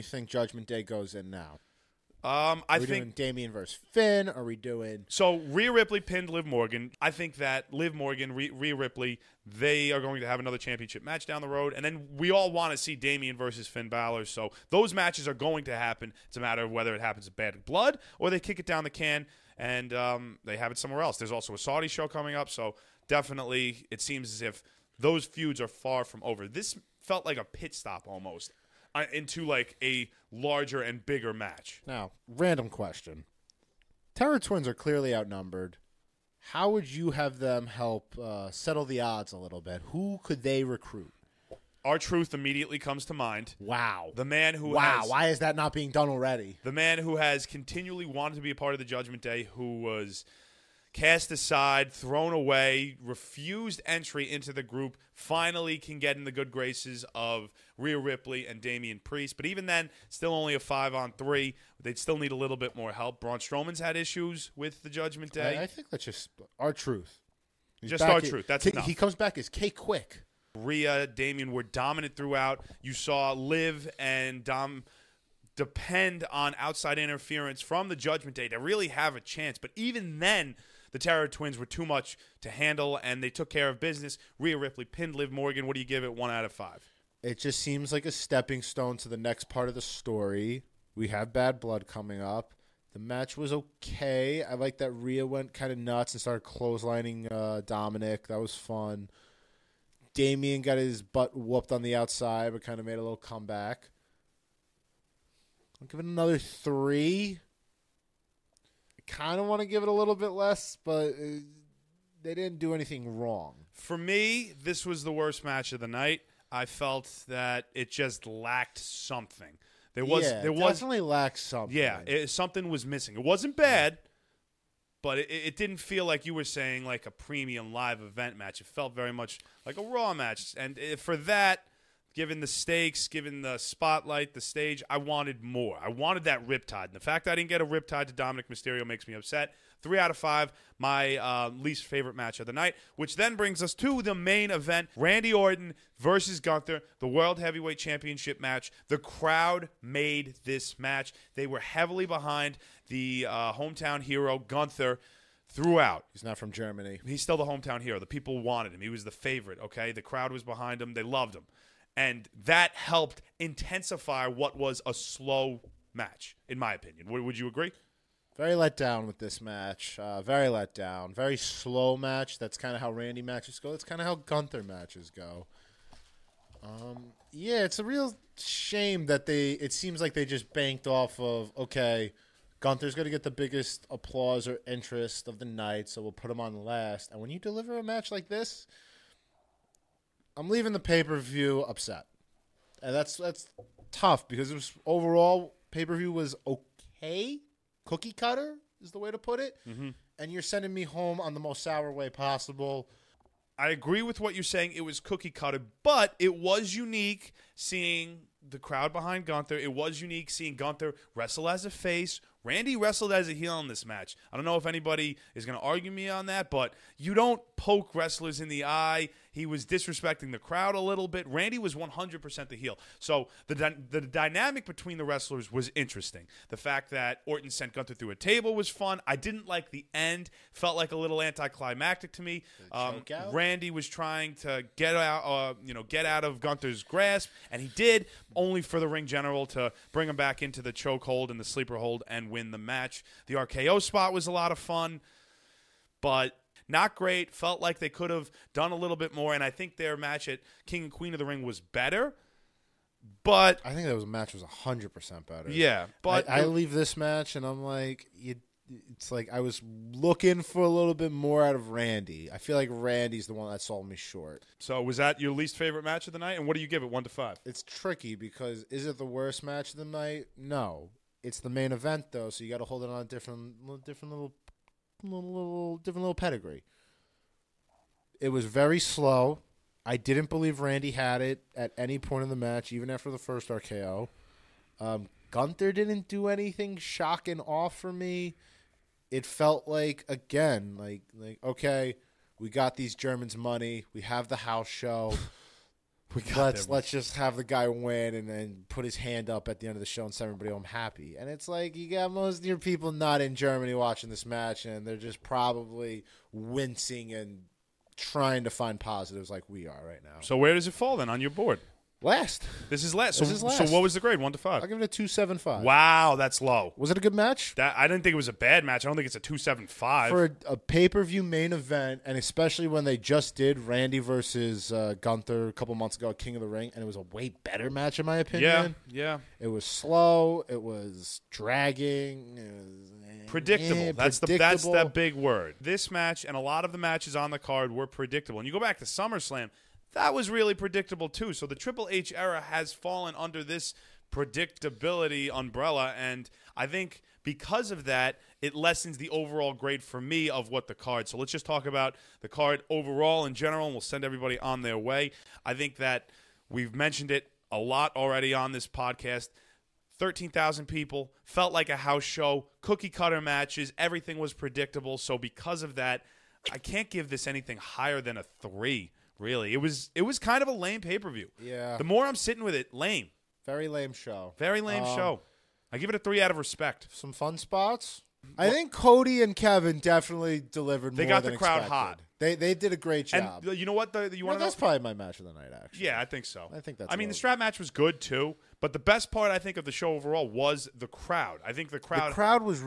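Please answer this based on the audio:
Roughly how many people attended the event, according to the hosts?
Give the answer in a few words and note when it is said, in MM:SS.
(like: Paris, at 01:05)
13,000, at 05:59.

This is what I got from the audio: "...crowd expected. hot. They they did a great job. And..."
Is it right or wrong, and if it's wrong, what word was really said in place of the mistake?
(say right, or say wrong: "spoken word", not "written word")
right.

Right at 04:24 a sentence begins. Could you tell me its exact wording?
So was that your least favorite match of the night?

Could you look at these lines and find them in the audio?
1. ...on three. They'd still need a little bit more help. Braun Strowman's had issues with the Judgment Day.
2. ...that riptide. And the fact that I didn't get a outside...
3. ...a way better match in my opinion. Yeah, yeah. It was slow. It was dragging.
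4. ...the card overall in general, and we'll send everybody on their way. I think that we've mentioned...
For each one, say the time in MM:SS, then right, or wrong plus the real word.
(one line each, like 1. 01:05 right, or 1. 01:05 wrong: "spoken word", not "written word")
1. 01:00 right
2. 02:16 wrong: "riptide", not "outside"
3. 05:26 right
4. 05:52 right.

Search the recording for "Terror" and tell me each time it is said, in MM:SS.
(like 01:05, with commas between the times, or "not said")
00:34, 01:21.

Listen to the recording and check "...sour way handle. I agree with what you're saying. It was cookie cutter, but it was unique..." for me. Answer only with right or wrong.
wrong.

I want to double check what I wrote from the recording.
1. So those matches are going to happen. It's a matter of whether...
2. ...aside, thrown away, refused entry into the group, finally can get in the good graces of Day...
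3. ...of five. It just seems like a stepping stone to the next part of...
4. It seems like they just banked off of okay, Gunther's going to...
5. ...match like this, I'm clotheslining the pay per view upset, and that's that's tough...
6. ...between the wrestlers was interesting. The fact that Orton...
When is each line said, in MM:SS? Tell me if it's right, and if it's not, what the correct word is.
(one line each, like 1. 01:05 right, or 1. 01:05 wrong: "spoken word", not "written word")
1. 00:14 right
2. 00:51 wrong: "Rhea", not "Day"
3. 01:26 right
4. 02:59 right
5. 03:07 wrong: "leaving", not "clotheslining"
6. 03:44 right.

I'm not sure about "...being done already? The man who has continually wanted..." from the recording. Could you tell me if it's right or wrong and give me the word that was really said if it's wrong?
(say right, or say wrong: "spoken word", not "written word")
right.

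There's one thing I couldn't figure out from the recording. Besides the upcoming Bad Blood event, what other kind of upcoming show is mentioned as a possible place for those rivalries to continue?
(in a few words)
Saudi show.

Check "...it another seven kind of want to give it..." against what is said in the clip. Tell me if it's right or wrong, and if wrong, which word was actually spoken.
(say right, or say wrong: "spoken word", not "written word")
wrong: "three", not "seven".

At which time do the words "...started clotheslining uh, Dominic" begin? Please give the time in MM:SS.
01:36.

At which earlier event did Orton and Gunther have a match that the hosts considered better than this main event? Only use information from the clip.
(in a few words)
King and Queen of the Ring.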